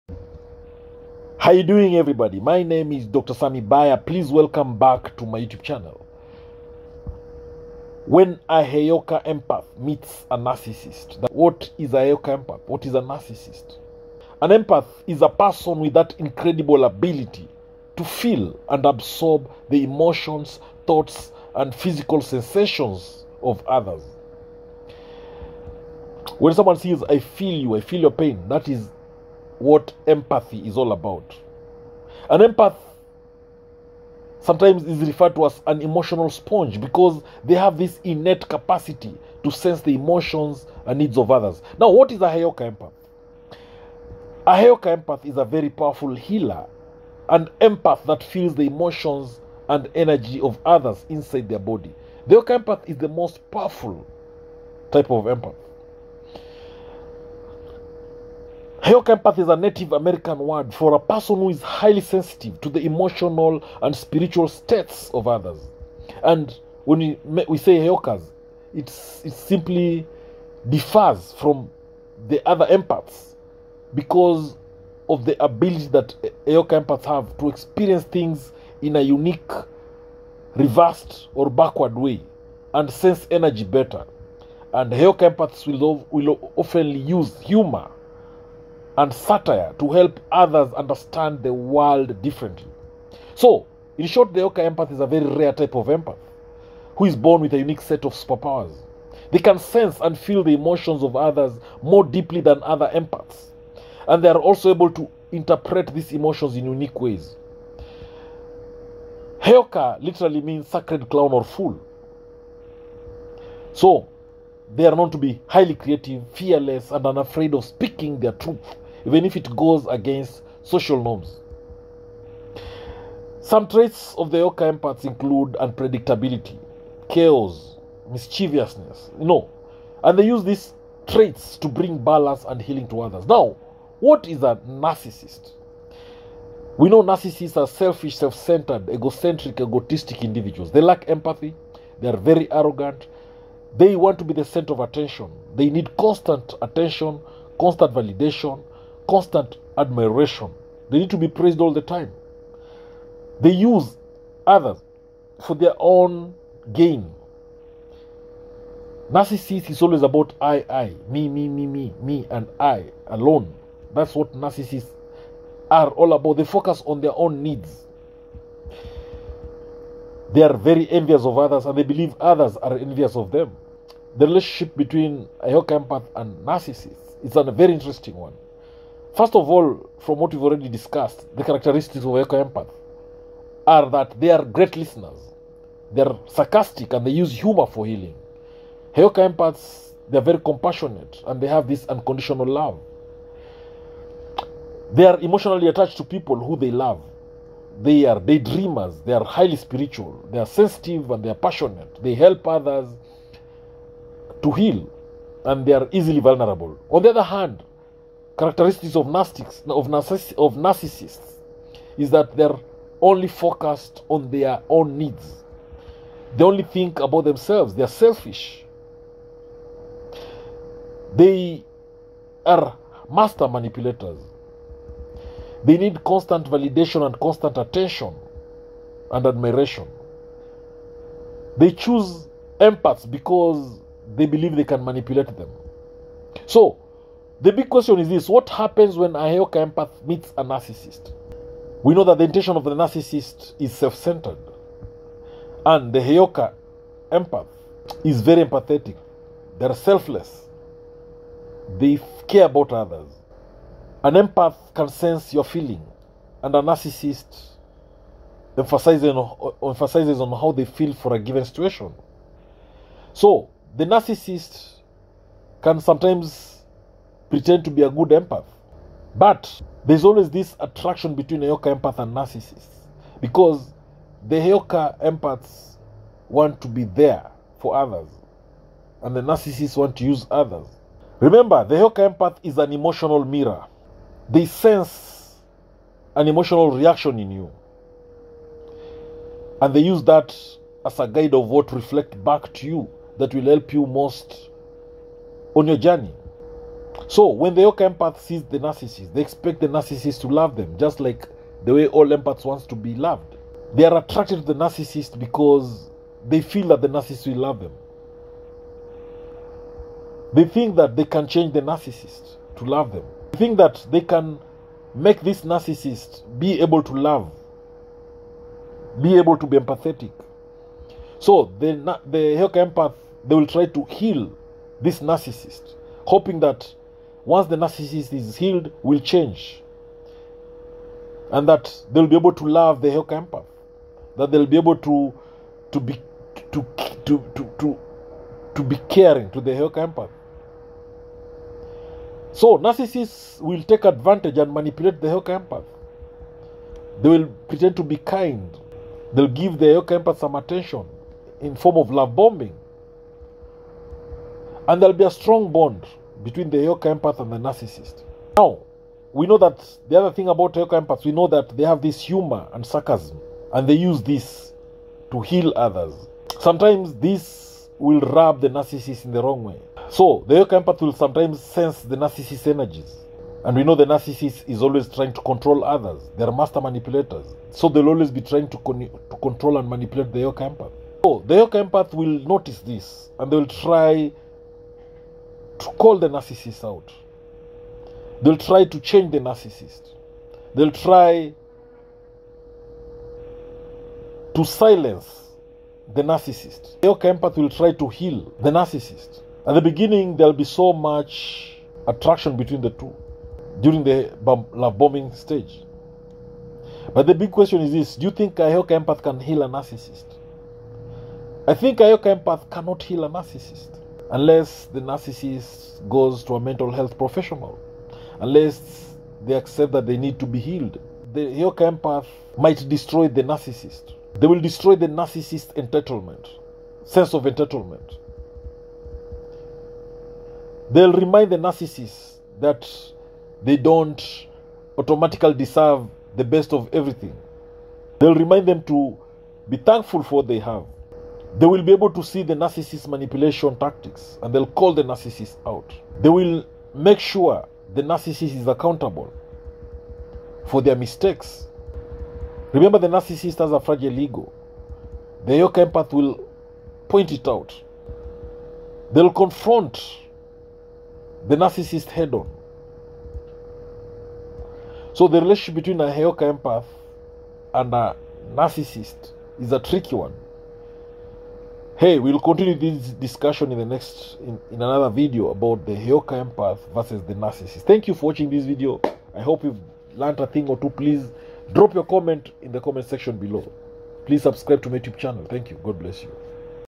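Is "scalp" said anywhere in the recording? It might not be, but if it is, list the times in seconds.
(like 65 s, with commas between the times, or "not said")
not said.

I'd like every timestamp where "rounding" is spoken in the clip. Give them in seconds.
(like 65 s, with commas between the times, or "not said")
not said.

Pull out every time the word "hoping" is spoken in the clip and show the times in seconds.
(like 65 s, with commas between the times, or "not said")
326 s.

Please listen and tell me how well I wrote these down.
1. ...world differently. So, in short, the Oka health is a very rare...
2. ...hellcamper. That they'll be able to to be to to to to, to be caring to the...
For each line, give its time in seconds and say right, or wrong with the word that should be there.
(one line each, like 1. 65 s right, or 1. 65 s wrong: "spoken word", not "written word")
1. 91 s wrong: "empath", not "health"
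2. 332 s right.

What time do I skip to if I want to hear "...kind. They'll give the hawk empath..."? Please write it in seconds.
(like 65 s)
347 s.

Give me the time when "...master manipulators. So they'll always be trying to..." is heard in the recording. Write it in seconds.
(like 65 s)
376 s.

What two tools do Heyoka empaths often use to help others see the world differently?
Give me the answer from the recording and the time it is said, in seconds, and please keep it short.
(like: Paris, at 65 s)
humor and satire, at 87 s.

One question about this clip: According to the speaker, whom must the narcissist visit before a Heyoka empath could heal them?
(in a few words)
a mental health professional.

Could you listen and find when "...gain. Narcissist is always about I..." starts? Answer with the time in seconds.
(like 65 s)
156 s.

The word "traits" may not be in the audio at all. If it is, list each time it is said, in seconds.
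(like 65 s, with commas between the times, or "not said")
123 s, 131 s.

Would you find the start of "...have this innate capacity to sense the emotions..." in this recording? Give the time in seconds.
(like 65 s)
37 s.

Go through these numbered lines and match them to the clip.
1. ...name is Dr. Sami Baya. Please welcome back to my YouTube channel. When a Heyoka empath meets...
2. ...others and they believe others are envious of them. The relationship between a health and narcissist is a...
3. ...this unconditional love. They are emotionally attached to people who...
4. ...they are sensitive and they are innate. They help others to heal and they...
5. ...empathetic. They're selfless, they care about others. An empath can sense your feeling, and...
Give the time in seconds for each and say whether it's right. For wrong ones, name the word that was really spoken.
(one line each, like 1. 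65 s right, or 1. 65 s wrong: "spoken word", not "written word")
1. 2 s right
2. 171 s wrong: "empath", not "health"
3. 191 s right
4. 200 s wrong: "passionate", not "innate"
5. 248 s right.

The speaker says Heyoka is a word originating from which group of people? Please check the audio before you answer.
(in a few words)
Native American.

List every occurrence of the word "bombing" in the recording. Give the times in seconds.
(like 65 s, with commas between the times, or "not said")
352 s, 404 s.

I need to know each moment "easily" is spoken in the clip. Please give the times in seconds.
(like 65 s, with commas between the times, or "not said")
205 s.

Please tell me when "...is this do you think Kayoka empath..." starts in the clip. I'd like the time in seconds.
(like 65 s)
407 s.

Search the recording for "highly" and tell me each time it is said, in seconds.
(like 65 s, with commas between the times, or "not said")
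61 s, 115 s, 199 s.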